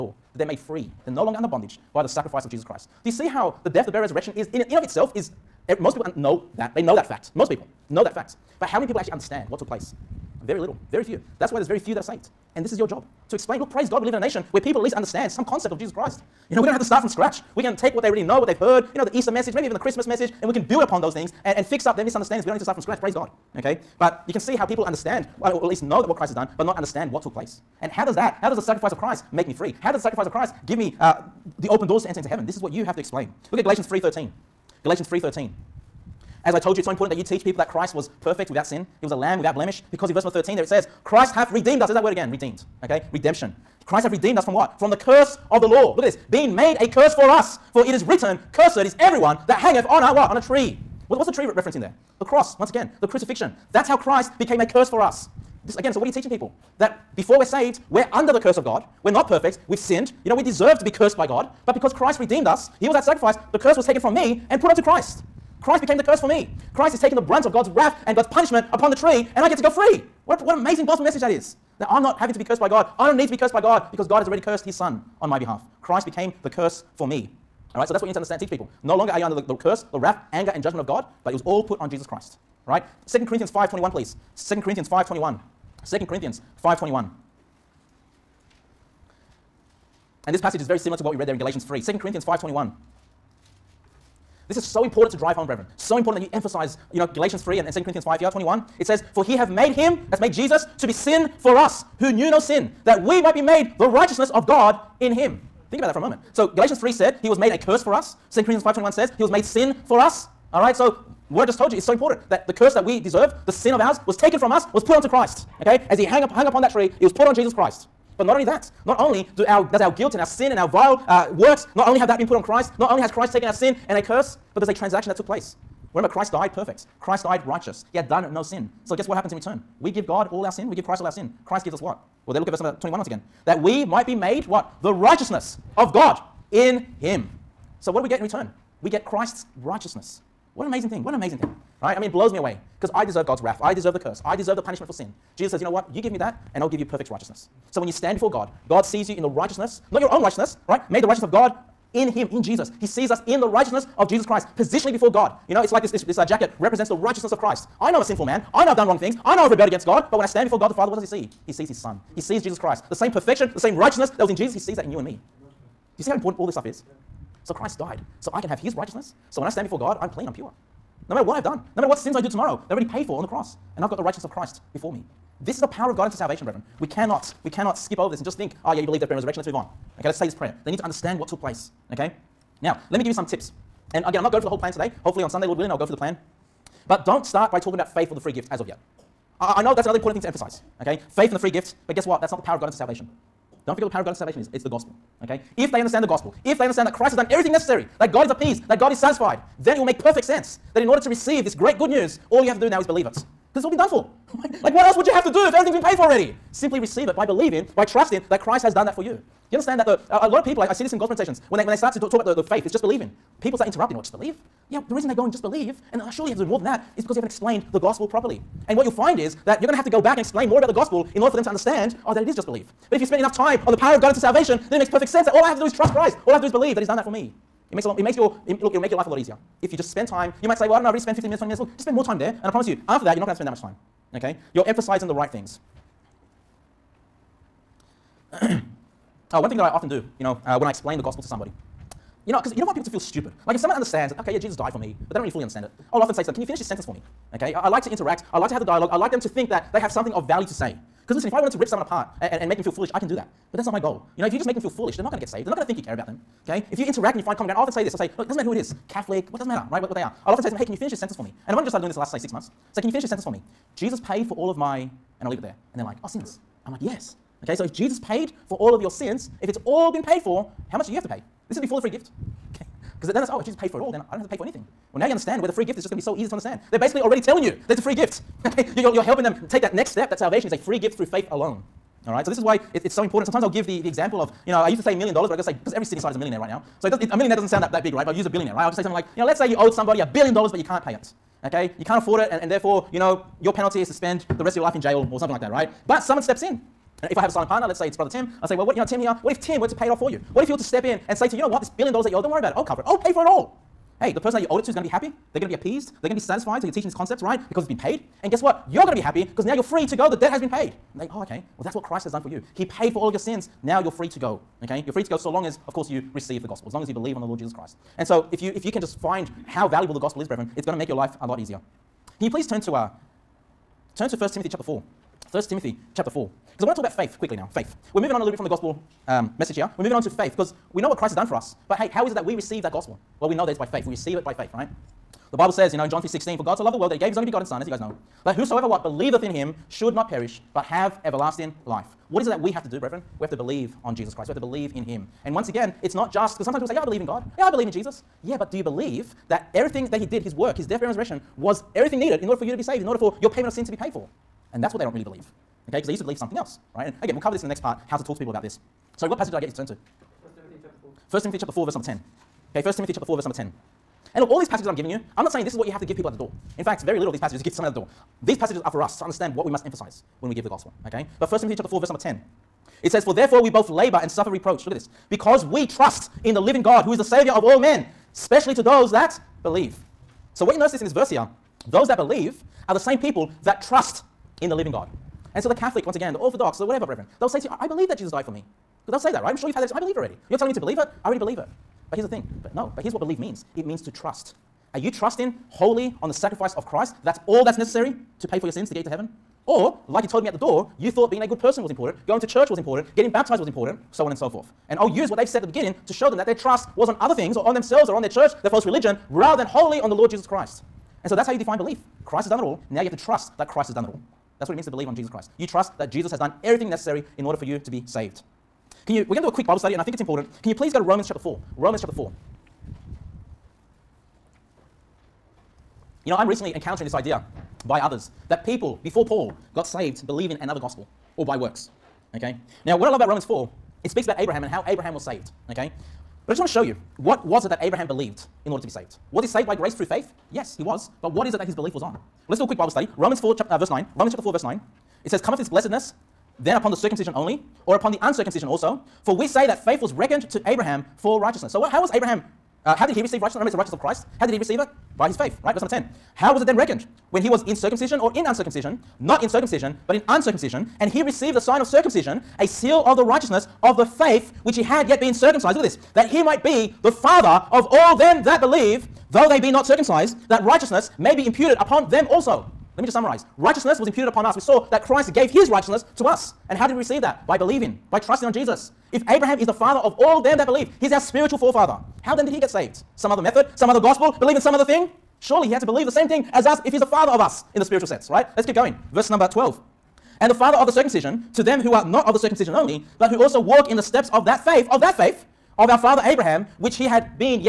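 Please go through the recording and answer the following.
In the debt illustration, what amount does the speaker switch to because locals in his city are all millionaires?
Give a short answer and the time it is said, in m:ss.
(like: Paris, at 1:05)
a billion dollars, at 4:49.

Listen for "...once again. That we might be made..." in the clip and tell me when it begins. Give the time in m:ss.
2:12.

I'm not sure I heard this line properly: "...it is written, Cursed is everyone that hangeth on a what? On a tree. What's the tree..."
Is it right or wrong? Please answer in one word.
right.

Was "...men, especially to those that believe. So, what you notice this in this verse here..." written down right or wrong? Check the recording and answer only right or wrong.
right.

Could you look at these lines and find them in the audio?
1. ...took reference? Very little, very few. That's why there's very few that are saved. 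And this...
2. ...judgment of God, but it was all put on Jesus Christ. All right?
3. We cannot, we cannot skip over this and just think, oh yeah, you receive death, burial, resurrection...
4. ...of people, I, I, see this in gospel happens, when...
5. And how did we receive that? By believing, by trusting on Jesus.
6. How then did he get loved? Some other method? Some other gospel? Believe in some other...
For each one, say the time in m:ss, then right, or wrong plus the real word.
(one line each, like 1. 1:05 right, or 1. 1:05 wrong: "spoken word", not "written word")
1. 0:09 wrong: "place", not "reference"
2. 1:20 right
3. 2:56 wrong: "believe", not "receive"
4. 3:30 wrong: "presentations", not "happens"
5. 7:56 right
6. 8:02 wrong: "saved", not "loved".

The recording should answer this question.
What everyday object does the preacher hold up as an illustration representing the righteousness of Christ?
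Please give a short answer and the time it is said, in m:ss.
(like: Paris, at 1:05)
jacket, at 2:36.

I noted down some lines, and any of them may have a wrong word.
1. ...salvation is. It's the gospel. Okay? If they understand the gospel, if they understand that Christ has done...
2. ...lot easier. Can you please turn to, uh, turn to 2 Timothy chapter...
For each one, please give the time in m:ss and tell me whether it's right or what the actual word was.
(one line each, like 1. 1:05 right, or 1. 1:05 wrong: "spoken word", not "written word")
1. 3:14 right
2. 5:21 wrong: "1", not "2".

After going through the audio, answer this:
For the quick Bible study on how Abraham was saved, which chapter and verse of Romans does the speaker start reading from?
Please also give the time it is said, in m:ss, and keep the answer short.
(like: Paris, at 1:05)
Romans 4:9, at 7:23.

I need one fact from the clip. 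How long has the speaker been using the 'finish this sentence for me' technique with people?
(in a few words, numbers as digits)
six months.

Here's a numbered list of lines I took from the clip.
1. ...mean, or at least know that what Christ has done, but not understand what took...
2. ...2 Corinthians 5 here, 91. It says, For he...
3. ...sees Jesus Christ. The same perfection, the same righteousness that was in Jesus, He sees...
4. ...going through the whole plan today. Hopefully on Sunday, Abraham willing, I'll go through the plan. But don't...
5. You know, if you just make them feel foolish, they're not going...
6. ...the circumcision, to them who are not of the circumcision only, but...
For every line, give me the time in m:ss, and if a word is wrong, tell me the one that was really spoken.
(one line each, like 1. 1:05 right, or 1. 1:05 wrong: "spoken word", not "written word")
1. 0:25 right
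2. 1:37 wrong: "21", not "91"
3. 2:42 right
4. 3:04 wrong: "Lord", not "Abraham"
5. 4:14 right
6. 8:10 right.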